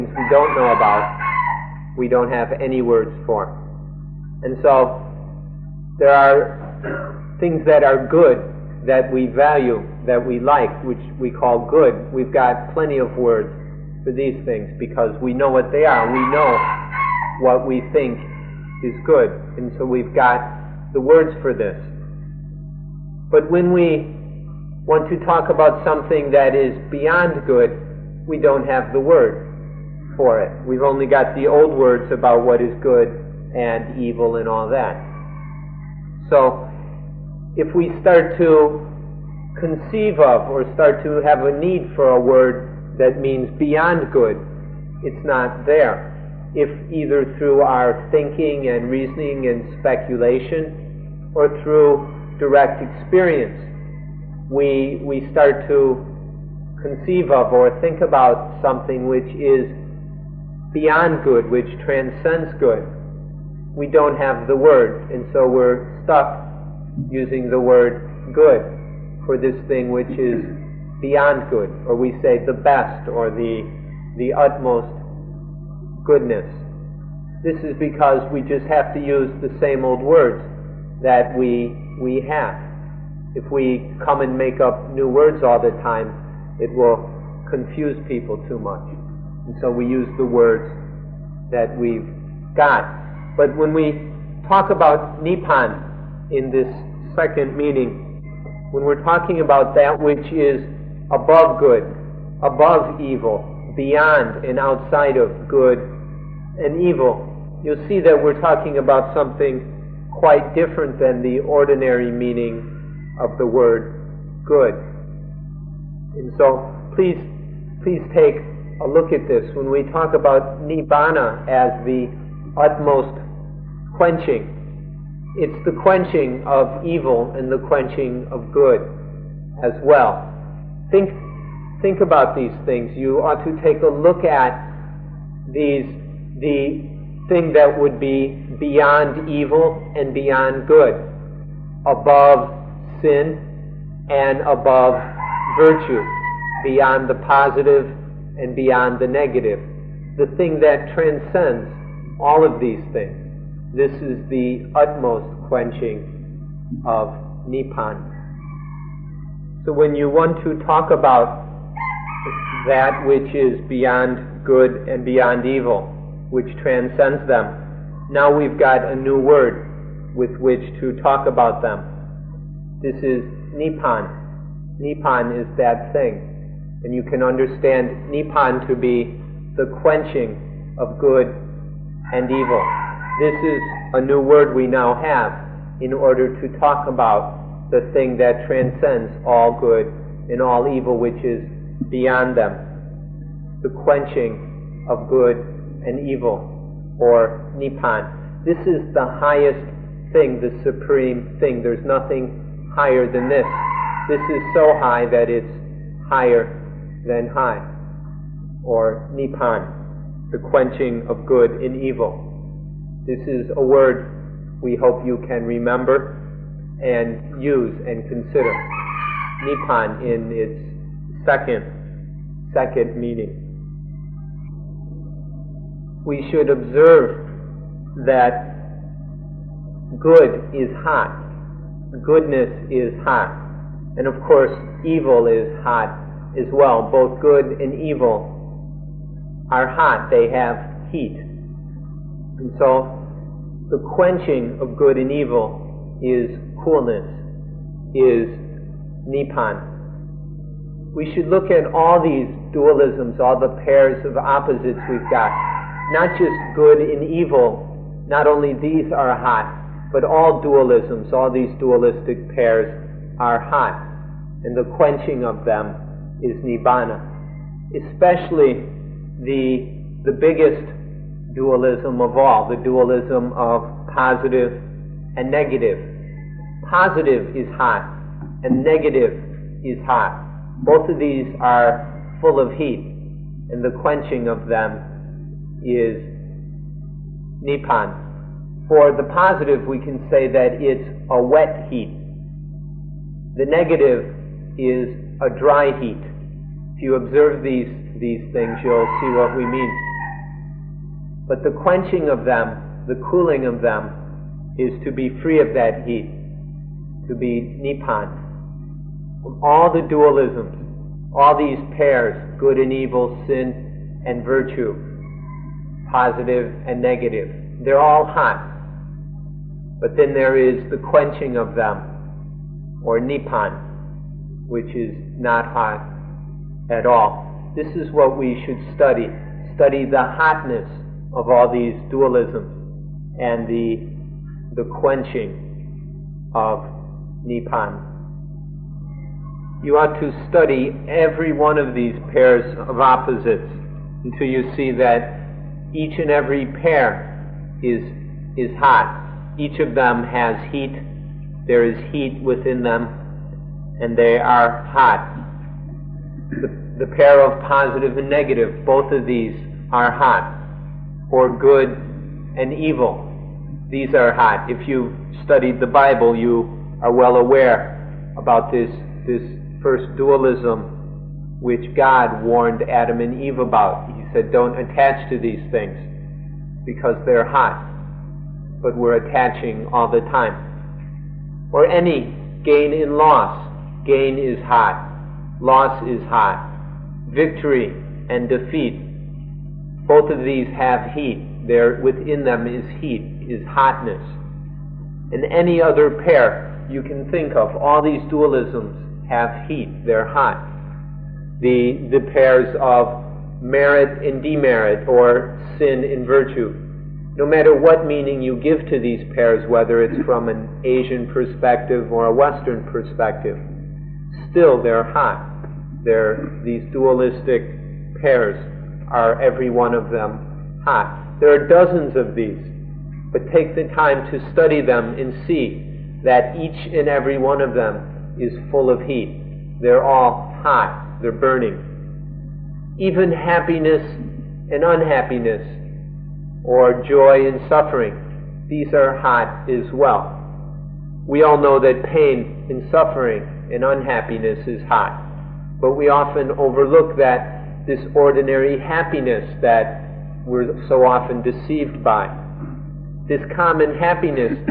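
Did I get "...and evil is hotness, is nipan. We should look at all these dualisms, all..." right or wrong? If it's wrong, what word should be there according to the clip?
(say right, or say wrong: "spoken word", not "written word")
wrong: "coolness", not "hotness".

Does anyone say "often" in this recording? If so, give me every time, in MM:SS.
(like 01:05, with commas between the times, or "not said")
07:25, 07:30.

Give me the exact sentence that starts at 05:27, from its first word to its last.
This is what we should study.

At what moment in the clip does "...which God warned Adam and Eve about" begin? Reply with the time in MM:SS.
06:11.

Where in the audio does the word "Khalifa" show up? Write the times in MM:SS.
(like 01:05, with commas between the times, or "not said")
not said.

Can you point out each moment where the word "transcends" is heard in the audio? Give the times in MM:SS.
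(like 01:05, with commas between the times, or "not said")
01:01, 02:30, 02:46, 03:08.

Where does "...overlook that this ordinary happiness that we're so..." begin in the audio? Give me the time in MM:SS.
07:26.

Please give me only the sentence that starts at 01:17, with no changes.
This is because we just have to use the same old words that we, we have.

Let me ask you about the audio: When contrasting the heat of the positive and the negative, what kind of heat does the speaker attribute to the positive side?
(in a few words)
wet heat.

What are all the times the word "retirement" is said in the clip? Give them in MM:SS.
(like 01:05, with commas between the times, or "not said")
not said.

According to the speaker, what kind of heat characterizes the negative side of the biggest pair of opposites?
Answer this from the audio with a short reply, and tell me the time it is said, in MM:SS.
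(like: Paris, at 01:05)
dry heat, at 04:55.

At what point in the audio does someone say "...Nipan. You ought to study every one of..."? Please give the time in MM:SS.
05:37.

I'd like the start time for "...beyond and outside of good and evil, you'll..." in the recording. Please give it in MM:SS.
01:43.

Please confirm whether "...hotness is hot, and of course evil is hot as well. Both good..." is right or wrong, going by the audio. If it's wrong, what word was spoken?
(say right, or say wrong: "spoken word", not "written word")
wrong: "goodness", not "hotness".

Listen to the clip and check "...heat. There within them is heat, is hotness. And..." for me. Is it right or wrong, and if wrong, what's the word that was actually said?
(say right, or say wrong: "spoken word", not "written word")
right.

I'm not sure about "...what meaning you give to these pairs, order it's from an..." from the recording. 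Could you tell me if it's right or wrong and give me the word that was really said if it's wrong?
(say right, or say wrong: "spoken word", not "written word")
wrong: "whether", not "order".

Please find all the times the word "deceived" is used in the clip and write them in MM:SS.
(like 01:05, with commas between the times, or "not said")
07:31.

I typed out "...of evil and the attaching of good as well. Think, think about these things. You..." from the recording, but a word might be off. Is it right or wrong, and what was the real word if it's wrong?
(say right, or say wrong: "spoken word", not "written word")
wrong: "quenching", not "attaching".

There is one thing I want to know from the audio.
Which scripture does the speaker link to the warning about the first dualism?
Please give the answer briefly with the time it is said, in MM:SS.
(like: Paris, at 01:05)
the Bible, at 06:05.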